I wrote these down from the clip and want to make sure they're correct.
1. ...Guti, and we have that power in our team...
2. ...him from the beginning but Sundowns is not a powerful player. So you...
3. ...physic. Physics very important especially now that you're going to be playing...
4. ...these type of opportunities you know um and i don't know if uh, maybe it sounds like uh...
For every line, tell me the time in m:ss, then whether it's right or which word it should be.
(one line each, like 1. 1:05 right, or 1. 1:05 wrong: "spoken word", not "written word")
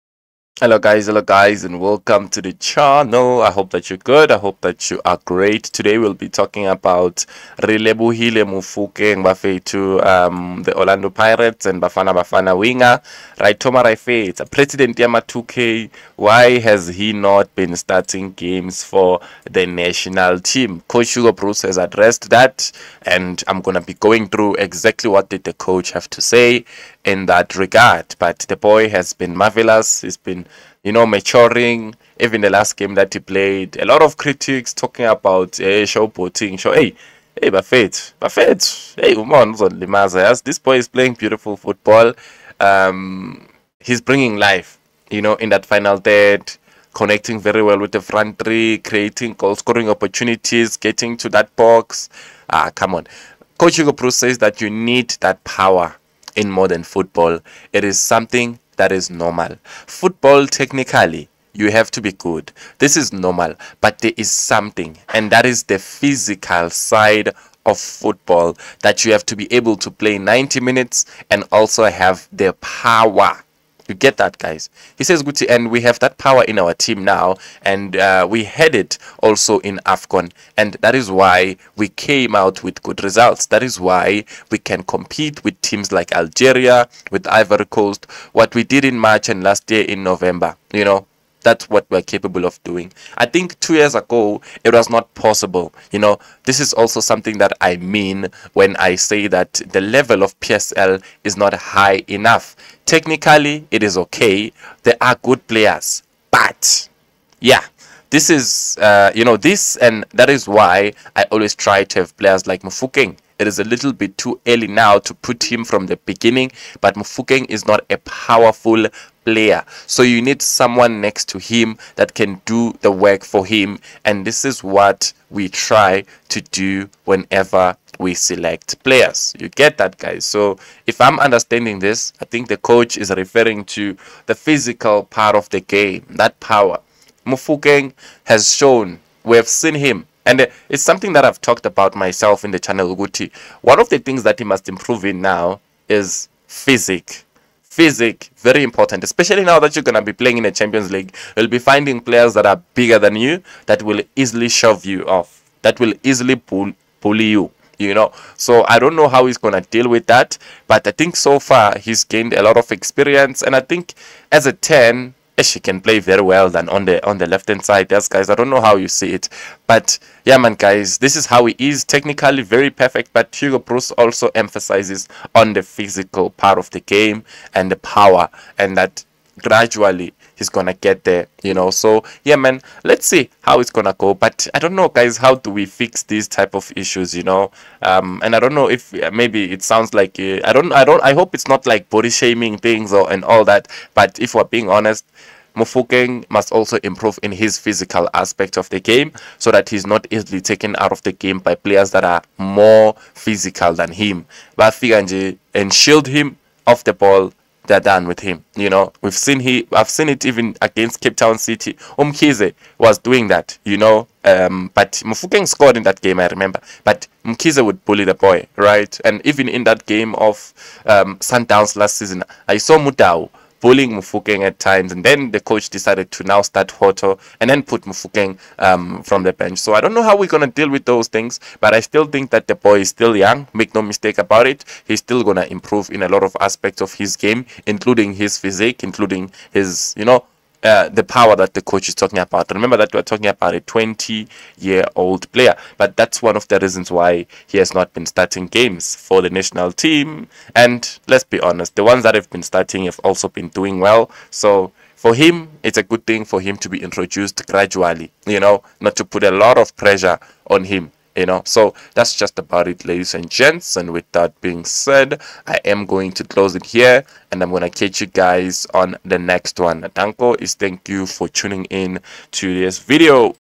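1. 1:15 right
2. 1:55 wrong: "Mofokeng", not "Sundowns"
3. 2:26 right
4. 3:06 wrong: "issues", not "opportunities".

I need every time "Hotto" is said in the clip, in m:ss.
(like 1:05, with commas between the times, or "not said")
3:46.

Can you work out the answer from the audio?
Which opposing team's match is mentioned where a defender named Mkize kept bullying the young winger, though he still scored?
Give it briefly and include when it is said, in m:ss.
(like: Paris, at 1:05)
Cape Town City, at 3:31.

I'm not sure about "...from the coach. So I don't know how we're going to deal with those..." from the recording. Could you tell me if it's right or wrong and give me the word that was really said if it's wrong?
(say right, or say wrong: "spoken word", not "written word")
wrong: "bench", not "coach".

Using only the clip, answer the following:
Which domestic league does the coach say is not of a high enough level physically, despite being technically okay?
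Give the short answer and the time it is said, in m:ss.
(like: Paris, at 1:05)
PSL, at 1:40.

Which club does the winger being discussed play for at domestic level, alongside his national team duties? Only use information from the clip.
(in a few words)
Orlando Pirates.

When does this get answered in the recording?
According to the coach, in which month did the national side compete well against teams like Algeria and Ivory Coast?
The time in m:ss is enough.
1:28.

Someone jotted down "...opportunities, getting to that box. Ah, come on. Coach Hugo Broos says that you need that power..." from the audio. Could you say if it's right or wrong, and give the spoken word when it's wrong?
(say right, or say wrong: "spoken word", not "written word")
right.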